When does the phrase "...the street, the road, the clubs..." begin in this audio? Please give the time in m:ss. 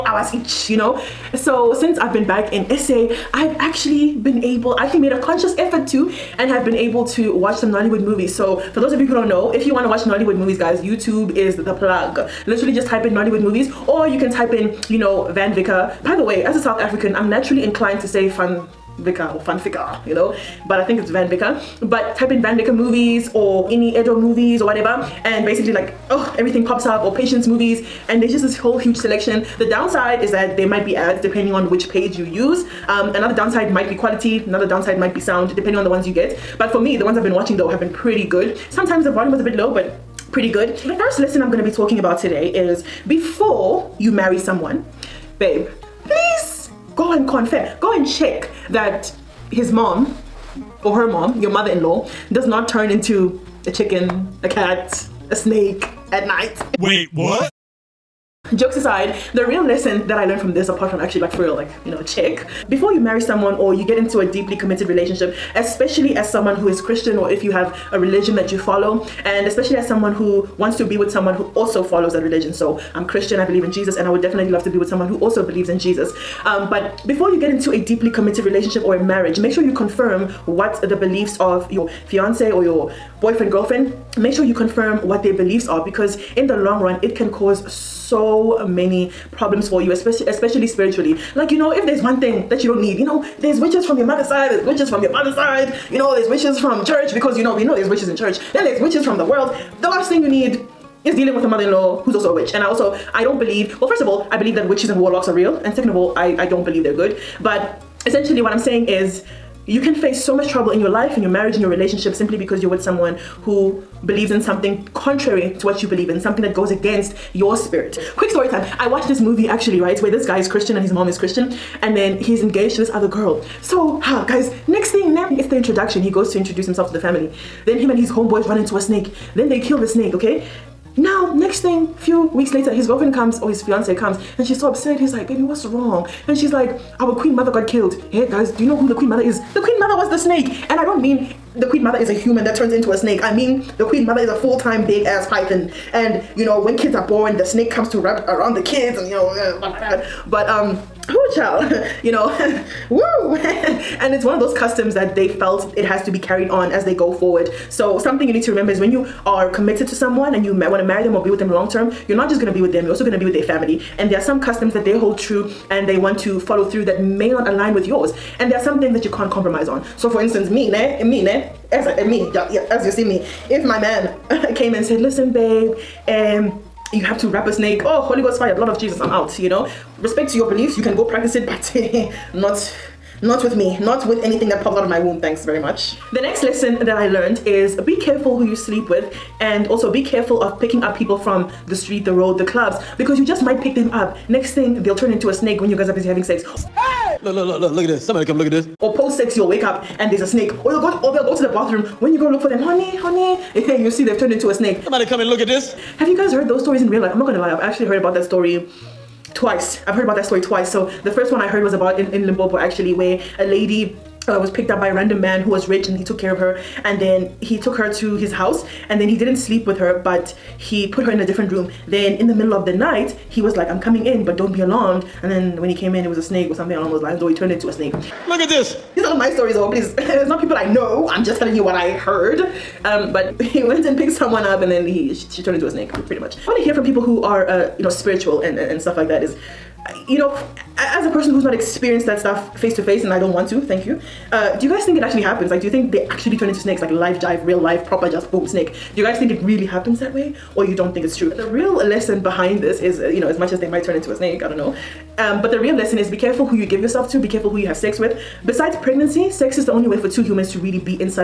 3:11.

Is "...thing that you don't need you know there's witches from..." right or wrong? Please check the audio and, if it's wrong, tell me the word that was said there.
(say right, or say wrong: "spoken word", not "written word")
right.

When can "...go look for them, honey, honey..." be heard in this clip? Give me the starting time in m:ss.
3:22.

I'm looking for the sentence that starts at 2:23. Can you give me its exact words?
I mean, the queen mother is a full-time big-ass python.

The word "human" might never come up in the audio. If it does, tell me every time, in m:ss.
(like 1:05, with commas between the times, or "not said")
2:22, 4:20.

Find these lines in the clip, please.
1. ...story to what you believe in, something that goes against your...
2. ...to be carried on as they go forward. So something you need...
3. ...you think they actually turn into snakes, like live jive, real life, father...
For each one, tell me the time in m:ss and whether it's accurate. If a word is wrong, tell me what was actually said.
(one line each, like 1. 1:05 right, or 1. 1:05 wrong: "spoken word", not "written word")
1. 1:54 wrong: "contrary", not "story"
2. 2:36 right
3. 4:05 wrong: "proper", not "father".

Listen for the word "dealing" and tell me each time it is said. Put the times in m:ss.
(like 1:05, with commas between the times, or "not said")
1:41.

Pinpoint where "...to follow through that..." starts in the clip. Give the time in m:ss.
2:46.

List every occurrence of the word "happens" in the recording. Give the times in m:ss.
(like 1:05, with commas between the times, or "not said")
4:05, 4:09.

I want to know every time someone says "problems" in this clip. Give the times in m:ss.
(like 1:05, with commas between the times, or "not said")
1:29.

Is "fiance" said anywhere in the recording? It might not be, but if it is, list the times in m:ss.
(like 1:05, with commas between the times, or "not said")
1:22, 2:13.